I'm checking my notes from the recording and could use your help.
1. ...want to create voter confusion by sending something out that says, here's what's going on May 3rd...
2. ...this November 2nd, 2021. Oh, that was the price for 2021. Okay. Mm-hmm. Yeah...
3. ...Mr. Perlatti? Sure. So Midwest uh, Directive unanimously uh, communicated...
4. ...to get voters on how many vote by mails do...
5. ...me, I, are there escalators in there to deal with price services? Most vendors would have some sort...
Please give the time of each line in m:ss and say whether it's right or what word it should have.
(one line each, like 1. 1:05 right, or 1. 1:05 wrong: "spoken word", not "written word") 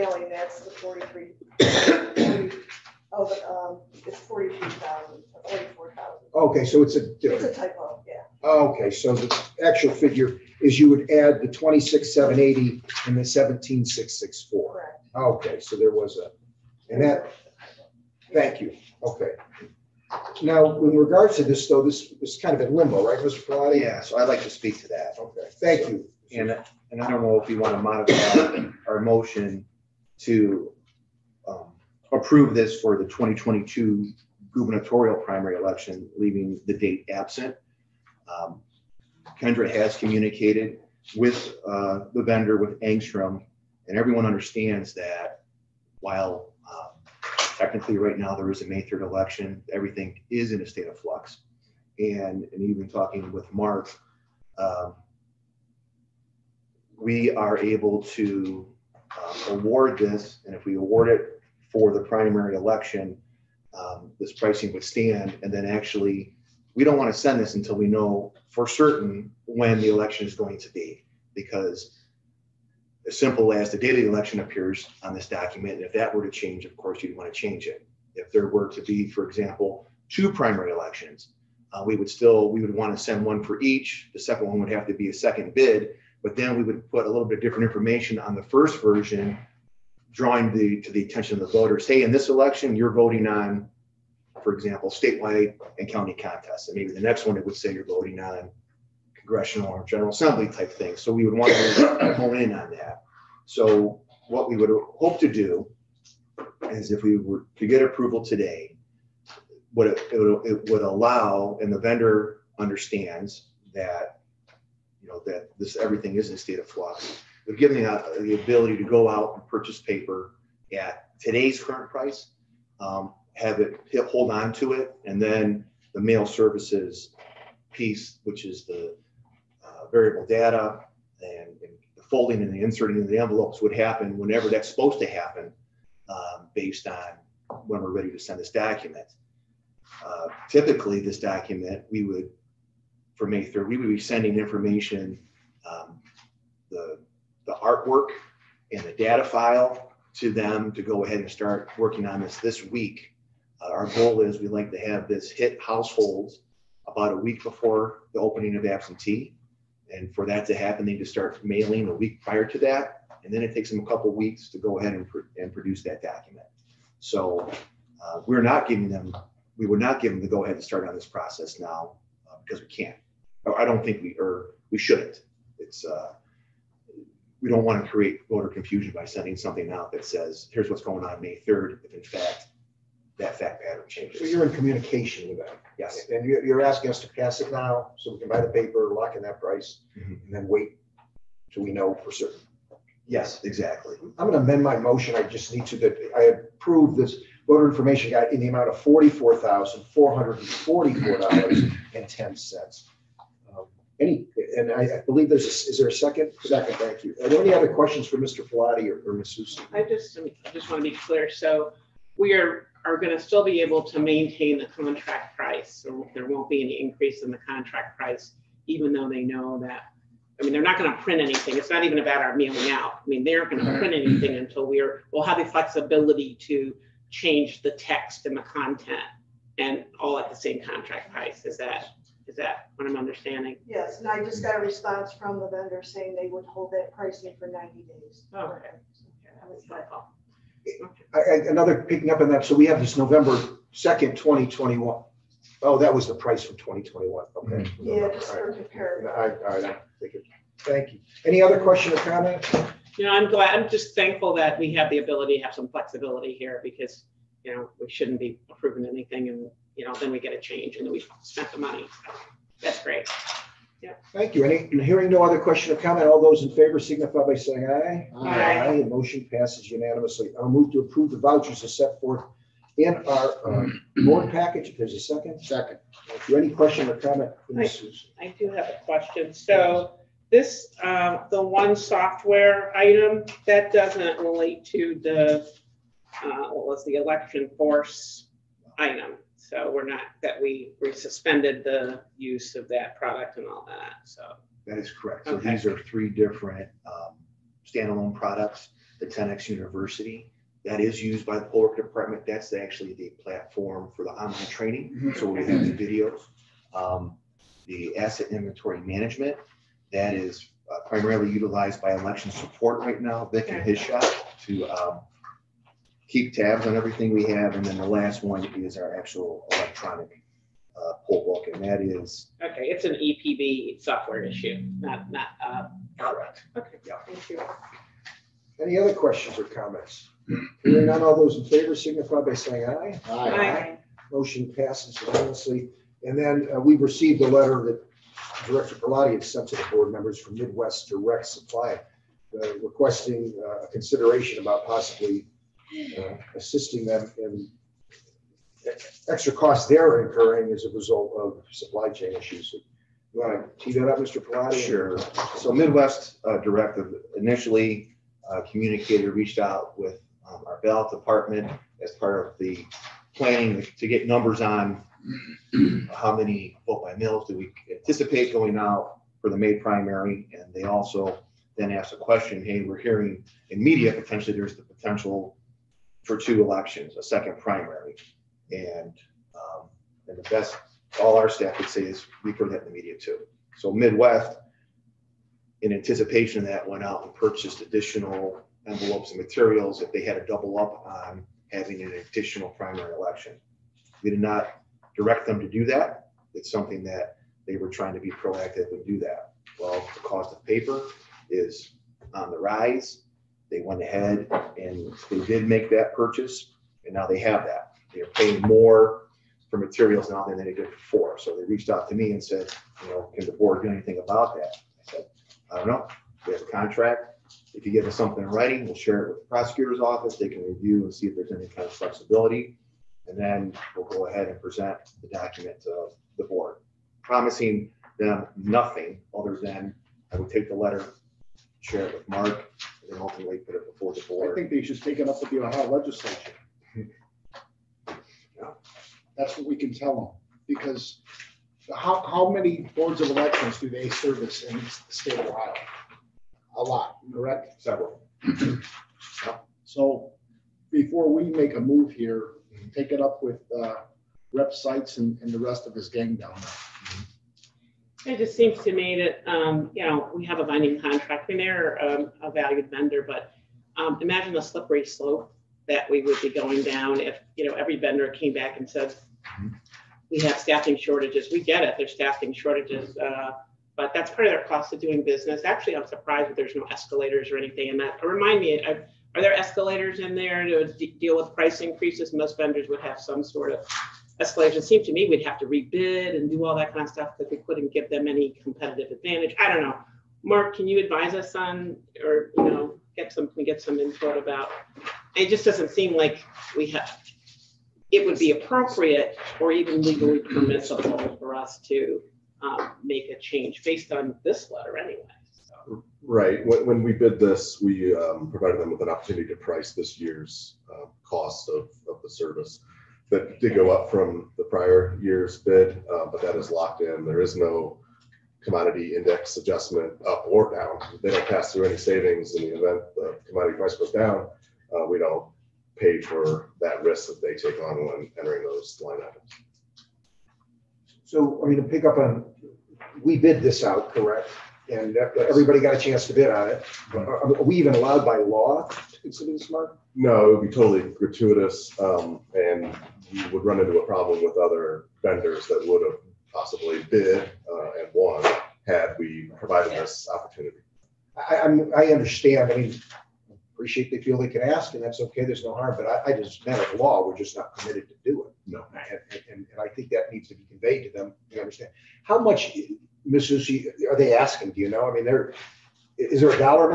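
1. 2:57 right
2. 4:02 right
3. 5:53 wrong: "initially", not "unanimously"
4. 6:03 wrong: "numbers", not "voters"
5. 7:58 wrong: "increases", not "services".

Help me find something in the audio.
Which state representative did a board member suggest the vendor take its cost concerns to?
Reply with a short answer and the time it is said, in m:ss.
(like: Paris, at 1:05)
Rep Sites, at 7:34.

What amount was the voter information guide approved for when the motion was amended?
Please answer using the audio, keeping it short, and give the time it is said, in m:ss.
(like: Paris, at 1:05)
$44,444.10, at 3:18.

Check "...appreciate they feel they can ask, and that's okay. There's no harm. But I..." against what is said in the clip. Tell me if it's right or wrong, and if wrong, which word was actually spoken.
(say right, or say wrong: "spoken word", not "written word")
right.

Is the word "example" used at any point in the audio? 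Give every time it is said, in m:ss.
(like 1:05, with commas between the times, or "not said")
1:19, 1:34.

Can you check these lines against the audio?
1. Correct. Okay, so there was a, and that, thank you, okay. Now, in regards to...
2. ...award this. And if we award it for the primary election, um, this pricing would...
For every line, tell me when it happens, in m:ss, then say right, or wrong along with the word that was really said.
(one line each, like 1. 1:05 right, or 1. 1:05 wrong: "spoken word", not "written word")
1. 0:14 right
2. 0:59 right.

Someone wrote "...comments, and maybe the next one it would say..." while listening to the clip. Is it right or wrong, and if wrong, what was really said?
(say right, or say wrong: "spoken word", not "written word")
wrong: "contests", not "comments".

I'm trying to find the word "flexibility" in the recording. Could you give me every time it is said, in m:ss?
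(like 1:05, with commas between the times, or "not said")
3:45, 4:15, 7:01.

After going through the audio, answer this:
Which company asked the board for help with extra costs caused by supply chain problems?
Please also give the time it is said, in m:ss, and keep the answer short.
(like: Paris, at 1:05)
Midwest Direct Supply, at 5:40.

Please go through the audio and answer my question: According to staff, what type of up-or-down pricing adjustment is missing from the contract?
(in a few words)
commodity index adjustment.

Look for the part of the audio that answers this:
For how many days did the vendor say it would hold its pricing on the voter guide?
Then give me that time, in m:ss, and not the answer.
3:57.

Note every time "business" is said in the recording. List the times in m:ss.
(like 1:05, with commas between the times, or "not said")
7:55.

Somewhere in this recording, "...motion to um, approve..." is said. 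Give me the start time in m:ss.
0:28.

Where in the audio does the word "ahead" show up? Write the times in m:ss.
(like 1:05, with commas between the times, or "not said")
2:31, 2:44, 2:50, 6:43, 7:04.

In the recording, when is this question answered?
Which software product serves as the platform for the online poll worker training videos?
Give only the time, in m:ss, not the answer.
4:58.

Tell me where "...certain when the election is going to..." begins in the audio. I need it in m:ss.
1:08.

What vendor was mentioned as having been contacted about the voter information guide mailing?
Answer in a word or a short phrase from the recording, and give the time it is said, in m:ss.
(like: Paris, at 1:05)
Angstrom, at 0:42.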